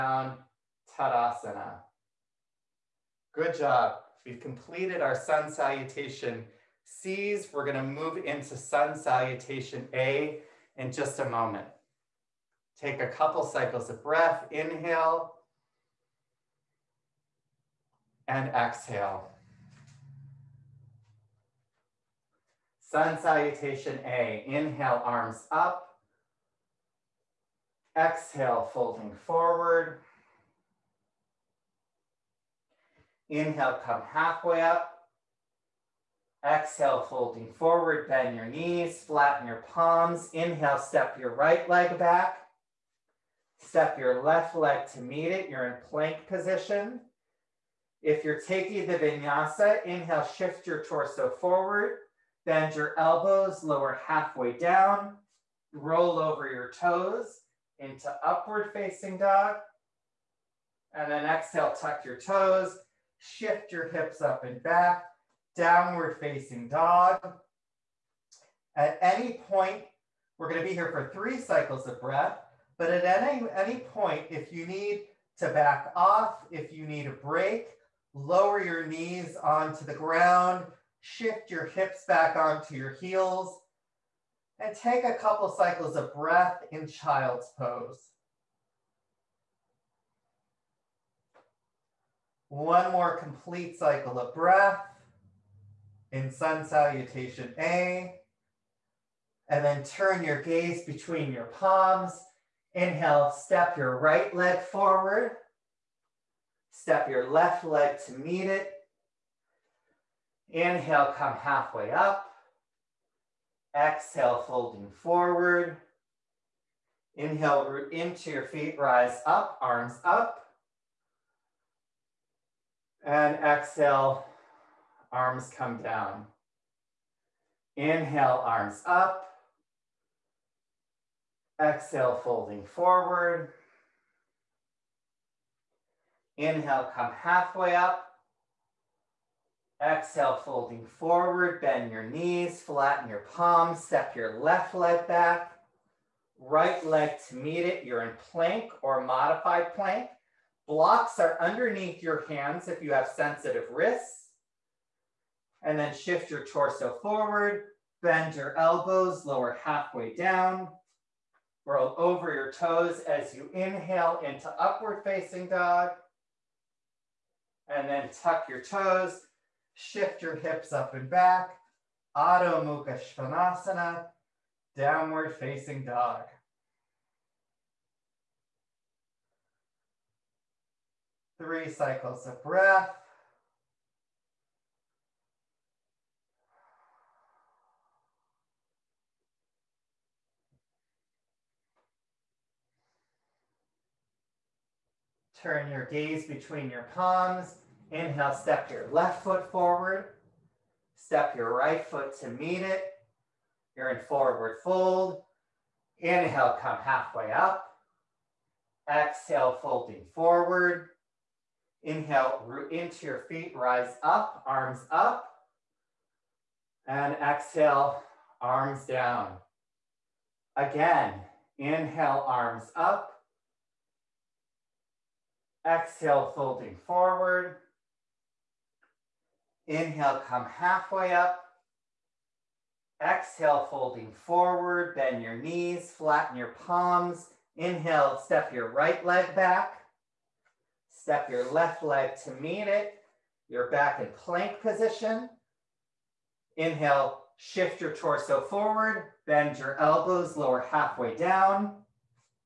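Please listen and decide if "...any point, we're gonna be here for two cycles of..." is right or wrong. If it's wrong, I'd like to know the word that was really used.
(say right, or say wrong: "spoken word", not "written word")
wrong: "three", not "two".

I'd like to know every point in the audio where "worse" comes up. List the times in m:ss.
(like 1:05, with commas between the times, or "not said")
not said.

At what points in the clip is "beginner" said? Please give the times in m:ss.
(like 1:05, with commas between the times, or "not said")
not said.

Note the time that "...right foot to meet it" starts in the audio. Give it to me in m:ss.
3:21.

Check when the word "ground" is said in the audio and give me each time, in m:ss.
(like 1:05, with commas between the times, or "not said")
1:19.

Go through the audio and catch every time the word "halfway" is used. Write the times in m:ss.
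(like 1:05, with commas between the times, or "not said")
0:34, 0:54, 1:51, 2:17, 2:39, 3:26, 3:50, 4:10.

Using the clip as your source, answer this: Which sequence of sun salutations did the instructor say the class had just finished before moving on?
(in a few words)
Sun salutation C.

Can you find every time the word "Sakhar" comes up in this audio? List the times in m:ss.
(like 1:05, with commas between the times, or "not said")
not said.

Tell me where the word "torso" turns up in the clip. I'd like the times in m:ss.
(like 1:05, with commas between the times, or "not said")
0:50, 2:36, 4:07.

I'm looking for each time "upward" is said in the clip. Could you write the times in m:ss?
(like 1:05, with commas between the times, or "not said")
0:58, 2:44.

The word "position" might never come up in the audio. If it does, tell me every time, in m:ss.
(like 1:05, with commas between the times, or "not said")
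0:46, 4:04.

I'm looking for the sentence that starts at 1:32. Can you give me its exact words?
One more complete cycle of breath in sun salutation A, and then turn your gaze between your palms.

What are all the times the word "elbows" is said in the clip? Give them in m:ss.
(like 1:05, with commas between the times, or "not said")
0:52, 2:38, 4:09.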